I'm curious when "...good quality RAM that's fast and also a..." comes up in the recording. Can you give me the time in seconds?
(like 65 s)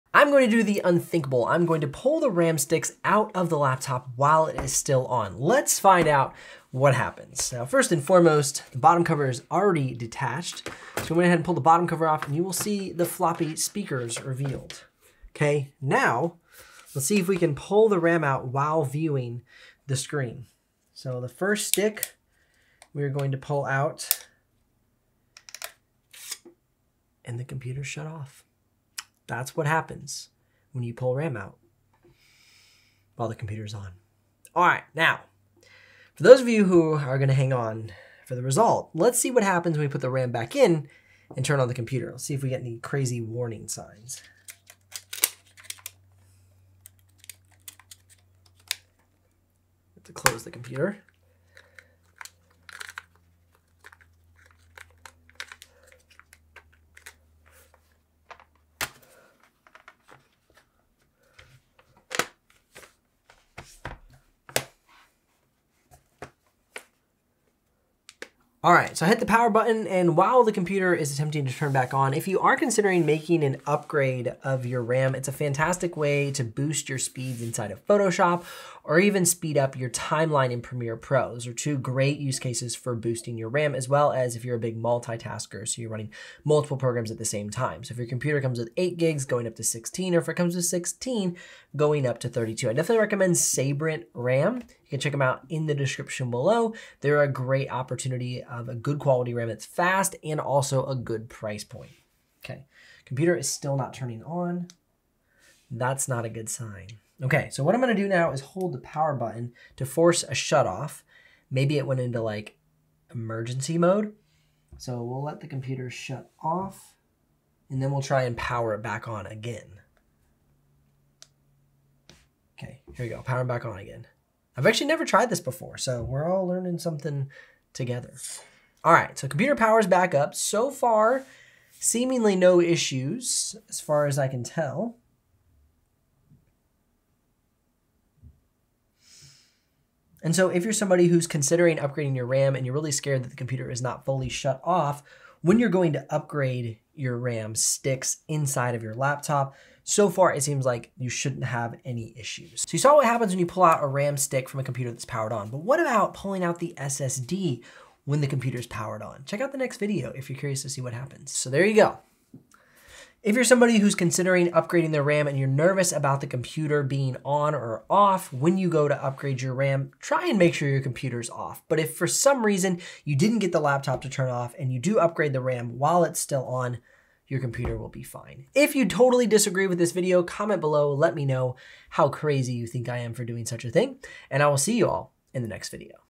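98 s.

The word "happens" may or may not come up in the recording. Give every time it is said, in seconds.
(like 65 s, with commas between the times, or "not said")
6 s, 29 s, 39 s, 153 s, 160 s.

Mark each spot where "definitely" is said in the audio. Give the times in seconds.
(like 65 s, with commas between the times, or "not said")
92 s.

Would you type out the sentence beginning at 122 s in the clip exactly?
Okay, here we go, powering back on again.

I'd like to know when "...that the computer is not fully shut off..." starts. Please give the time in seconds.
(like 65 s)
143 s.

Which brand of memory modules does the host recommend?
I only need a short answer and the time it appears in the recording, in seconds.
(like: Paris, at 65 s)
Sabrent, at 93 s.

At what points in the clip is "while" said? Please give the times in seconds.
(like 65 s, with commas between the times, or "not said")
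4 s, 18 s, 33 s, 70 s, 175 s.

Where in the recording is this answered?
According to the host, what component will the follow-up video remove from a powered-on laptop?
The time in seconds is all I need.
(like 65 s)
156 s.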